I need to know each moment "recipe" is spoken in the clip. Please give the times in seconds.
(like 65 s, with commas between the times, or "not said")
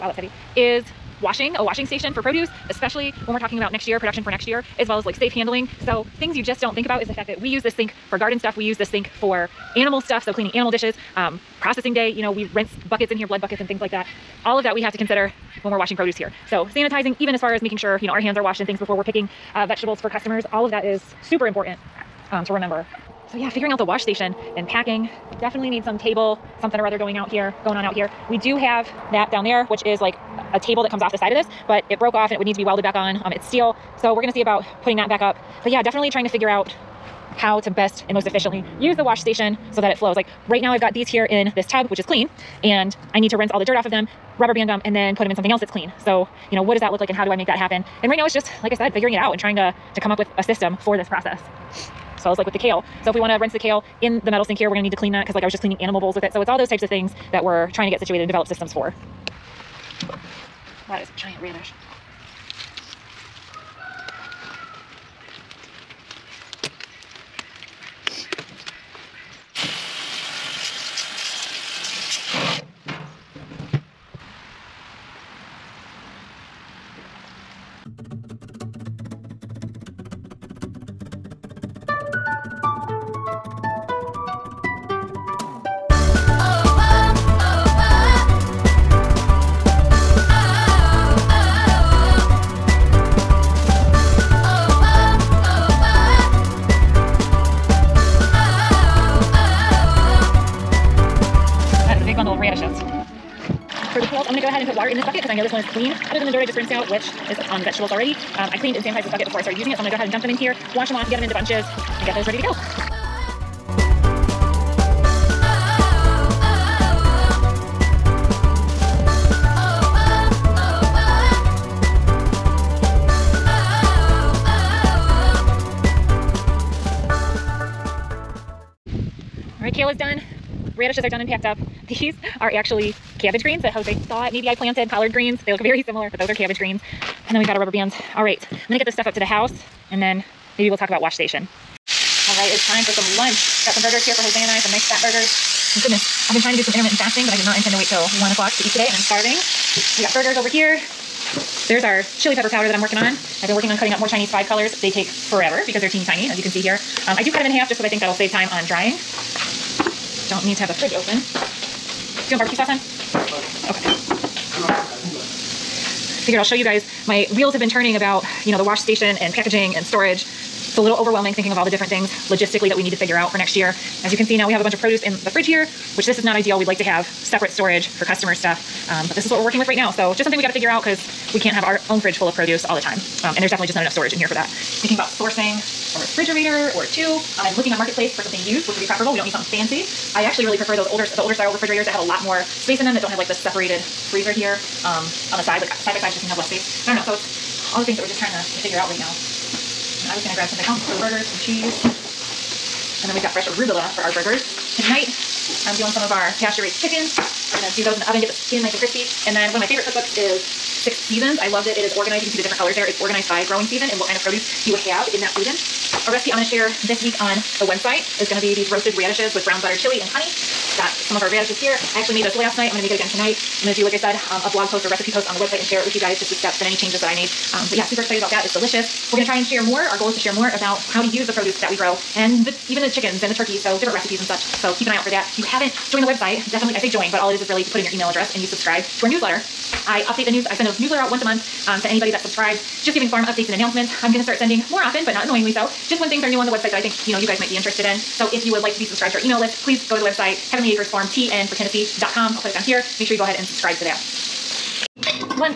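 216 s, 224 s, 233 s.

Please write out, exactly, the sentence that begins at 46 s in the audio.
So, you know, what does that look like and how do I make that happen?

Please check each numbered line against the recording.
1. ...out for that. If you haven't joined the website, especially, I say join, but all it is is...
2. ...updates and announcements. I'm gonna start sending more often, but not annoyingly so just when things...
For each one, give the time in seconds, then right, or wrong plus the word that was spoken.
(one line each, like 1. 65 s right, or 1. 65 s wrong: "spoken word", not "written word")
1. 234 s wrong: "definitely", not "especially"
2. 243 s right.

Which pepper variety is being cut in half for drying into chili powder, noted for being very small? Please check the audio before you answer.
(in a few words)
Chinese five colors.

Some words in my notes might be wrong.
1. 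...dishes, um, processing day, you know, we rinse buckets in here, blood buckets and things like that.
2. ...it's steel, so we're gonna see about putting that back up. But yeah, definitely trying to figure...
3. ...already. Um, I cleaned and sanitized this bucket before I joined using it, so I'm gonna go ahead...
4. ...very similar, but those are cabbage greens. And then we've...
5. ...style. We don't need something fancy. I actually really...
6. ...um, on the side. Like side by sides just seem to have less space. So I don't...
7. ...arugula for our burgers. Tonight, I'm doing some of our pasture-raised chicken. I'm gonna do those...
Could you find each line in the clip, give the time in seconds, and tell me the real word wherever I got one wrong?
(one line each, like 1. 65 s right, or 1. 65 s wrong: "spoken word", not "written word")
1. 10 s right
2. 33 s right
3. 107 s wrong: "started", not "joined"
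4. 135 s right
5. 188 s wrong: "preferable", not "style"
6. 194 s right
7. 203 s right.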